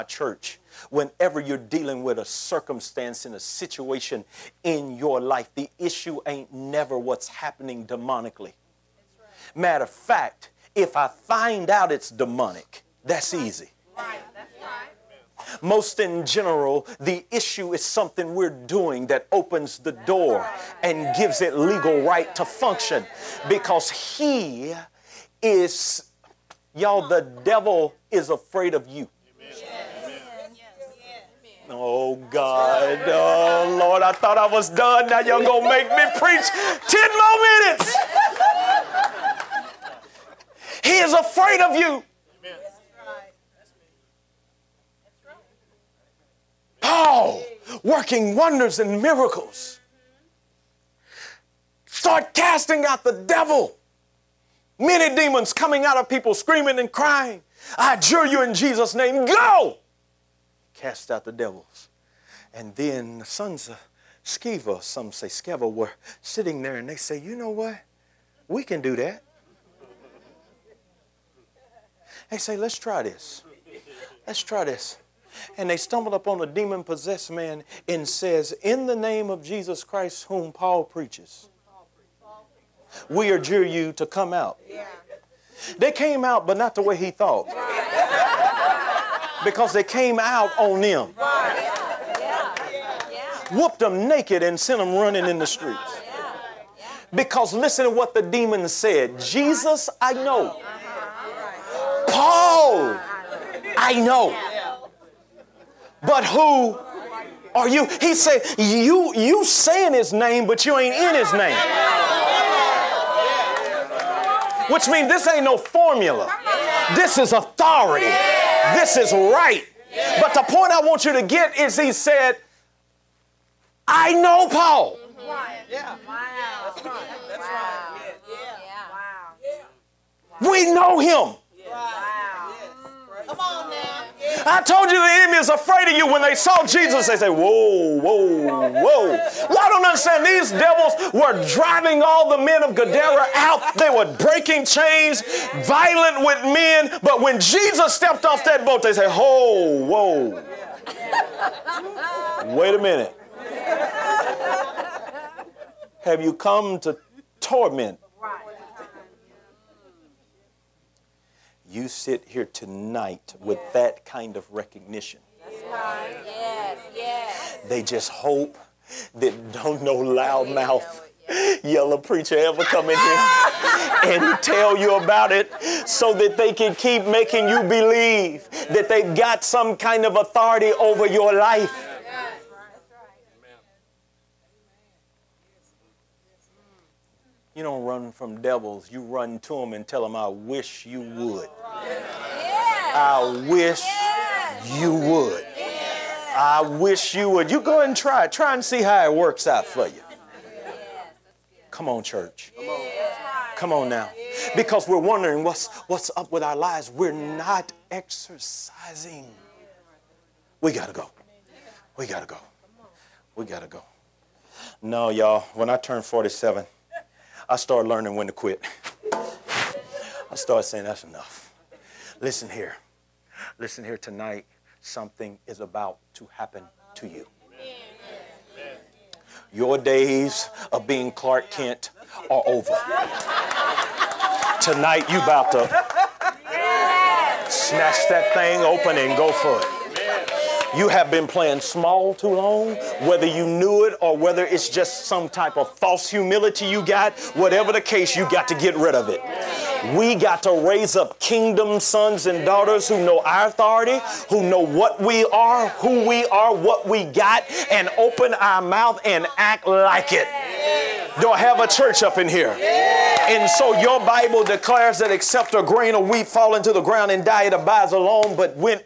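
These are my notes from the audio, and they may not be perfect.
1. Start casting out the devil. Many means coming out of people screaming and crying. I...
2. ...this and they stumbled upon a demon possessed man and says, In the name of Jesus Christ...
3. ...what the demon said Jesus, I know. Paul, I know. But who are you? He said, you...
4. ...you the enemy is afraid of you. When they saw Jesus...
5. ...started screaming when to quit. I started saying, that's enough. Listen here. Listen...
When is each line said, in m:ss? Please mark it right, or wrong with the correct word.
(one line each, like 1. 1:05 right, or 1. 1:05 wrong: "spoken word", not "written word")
1. 0:51 wrong: "demons", not "means"
2. 1:14 right
3. 1:37 right
4. 2:14 right
5. 3:37 wrong: "learning", not "screaming".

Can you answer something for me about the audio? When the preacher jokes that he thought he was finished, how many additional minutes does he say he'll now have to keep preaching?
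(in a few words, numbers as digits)
10.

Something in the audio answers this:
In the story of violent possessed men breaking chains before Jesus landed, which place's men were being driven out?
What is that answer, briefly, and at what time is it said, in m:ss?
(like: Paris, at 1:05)
Gadara, at 2:22.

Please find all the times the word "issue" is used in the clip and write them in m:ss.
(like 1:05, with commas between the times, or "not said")
0:05, 0:17.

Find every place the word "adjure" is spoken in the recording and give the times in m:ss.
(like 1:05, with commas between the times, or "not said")
0:57, 1:23.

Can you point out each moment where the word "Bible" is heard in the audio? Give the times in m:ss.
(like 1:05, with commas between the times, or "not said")
4:23.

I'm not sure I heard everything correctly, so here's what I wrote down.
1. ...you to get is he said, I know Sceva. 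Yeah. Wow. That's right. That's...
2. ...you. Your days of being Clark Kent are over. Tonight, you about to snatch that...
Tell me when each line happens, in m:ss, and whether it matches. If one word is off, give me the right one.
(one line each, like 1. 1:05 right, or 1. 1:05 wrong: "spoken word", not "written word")
1. 2:01 wrong: "Paul", not "Sceva"
2. 3:47 right.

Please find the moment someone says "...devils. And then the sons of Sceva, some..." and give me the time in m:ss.
1:01.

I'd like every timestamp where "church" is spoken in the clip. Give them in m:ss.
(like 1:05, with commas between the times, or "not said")
0:00, 3:22, 4:21.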